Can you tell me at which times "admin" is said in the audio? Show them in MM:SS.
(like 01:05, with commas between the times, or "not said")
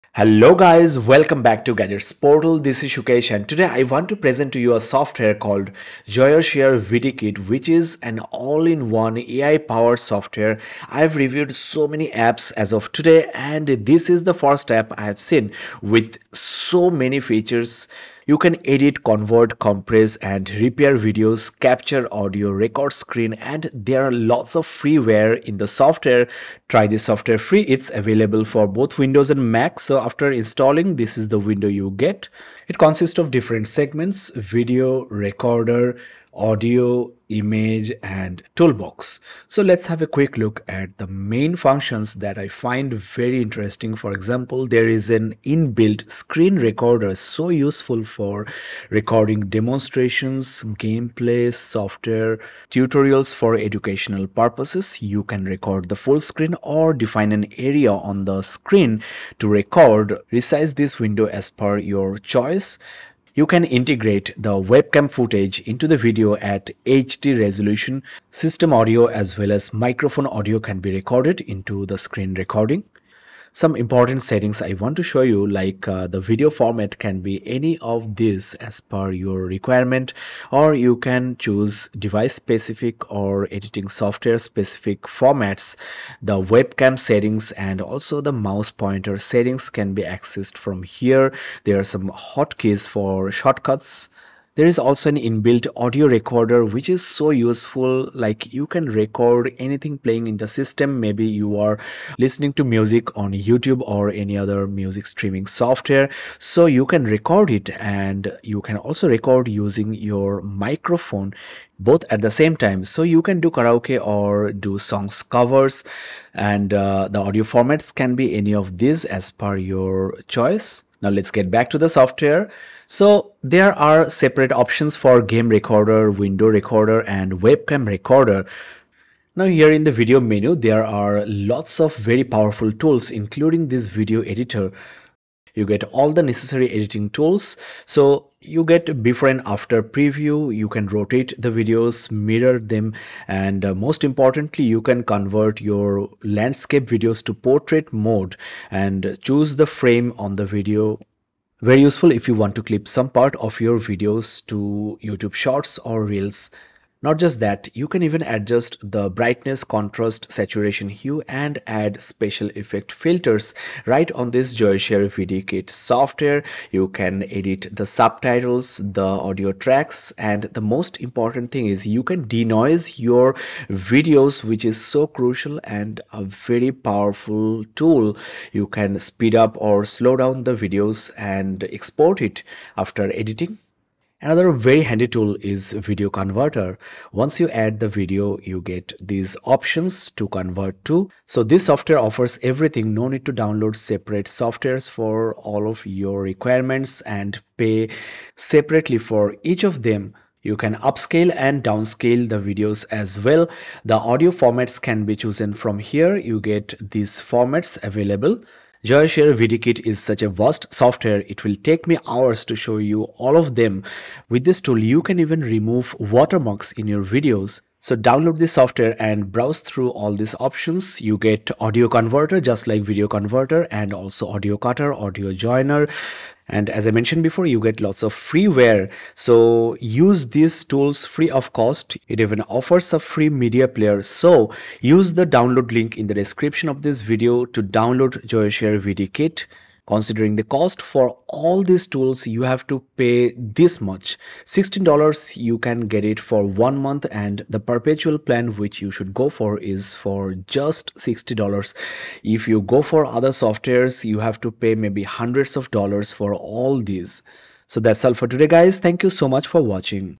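not said.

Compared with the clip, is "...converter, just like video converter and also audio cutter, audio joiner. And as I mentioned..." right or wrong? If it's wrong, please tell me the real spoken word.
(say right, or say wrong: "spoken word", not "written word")
right.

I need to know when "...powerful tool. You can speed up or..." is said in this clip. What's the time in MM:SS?
02:56.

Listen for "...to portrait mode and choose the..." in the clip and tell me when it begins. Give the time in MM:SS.
02:27.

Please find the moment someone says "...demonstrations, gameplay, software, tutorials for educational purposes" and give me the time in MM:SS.
00:49.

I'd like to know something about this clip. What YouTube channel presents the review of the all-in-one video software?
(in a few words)
Gadgets Portal.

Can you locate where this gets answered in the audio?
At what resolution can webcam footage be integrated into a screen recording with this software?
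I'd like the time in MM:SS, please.
01:06.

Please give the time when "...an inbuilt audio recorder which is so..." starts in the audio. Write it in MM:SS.
01:35.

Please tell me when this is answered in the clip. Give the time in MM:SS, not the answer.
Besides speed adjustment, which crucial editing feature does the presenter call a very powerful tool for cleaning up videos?
02:52.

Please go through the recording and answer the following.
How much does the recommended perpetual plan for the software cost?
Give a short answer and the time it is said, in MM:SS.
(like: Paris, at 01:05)
$60, at 04:10.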